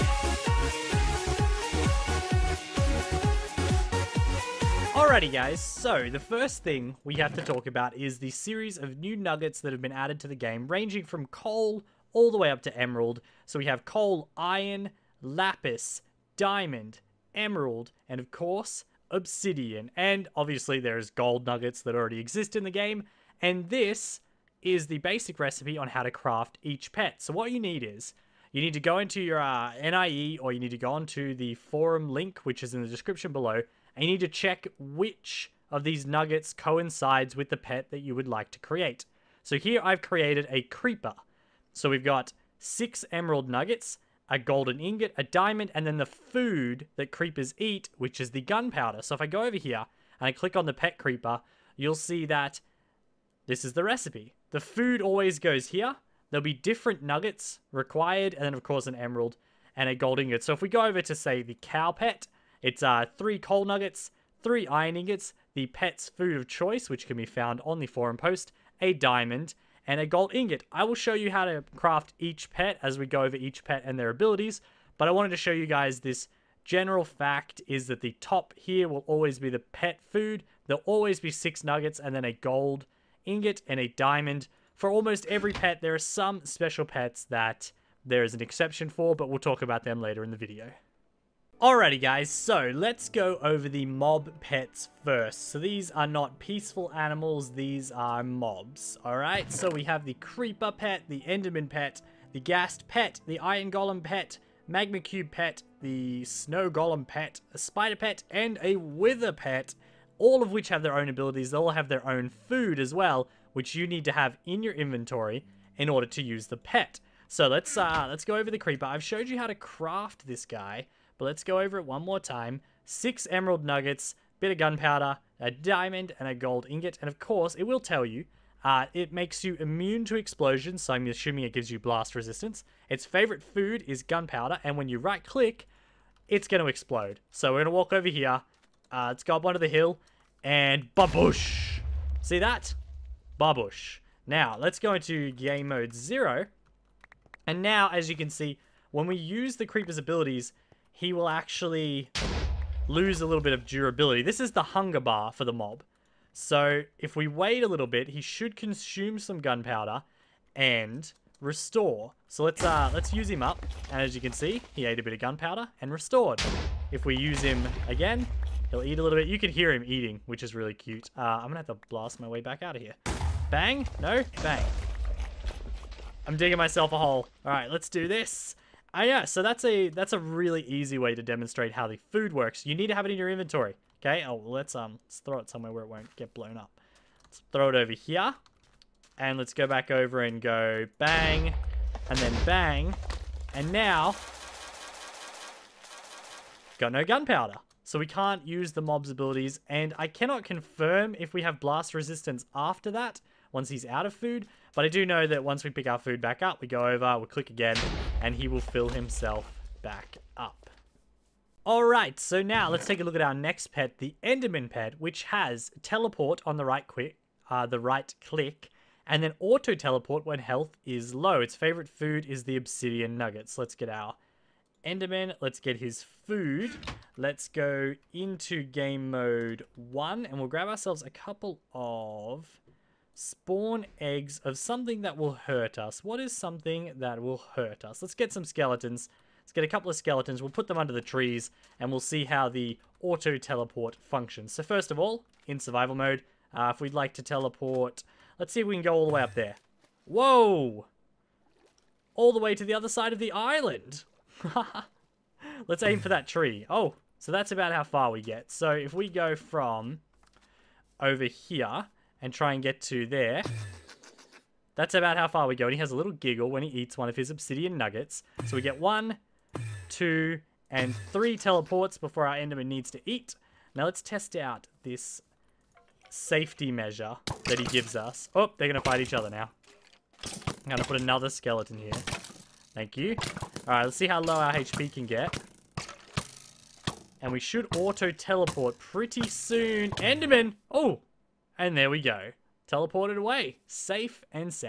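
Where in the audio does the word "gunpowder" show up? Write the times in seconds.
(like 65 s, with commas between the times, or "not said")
48 s, 124 s, 134 s, 159 s, 165 s, 197 s.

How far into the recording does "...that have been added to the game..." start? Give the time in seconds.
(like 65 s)
9 s.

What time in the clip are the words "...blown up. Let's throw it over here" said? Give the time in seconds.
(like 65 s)
186 s.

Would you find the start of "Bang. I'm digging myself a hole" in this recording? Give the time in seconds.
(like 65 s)
174 s.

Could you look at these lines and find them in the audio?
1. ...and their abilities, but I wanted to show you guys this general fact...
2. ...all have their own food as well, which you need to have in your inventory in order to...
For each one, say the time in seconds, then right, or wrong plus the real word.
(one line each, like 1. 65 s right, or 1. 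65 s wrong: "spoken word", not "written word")
1. 73 s right
2. 111 s right.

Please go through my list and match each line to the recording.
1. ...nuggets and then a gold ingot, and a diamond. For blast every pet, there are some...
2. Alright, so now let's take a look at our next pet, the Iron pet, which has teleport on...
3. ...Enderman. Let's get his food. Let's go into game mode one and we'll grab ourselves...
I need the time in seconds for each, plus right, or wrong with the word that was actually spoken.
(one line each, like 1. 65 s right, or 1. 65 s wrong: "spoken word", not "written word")
1. 81 s wrong: "almost", not "blast"
2. 211 s wrong: "Enderman", not "Iron"
3. 224 s right.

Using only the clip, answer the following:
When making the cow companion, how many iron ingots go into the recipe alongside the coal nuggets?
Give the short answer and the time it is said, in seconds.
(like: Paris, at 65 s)
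3, at 64 s.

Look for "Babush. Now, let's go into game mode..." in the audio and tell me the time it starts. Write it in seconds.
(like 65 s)
143 s.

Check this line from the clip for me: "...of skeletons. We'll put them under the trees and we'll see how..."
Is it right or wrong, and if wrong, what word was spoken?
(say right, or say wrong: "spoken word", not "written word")
right.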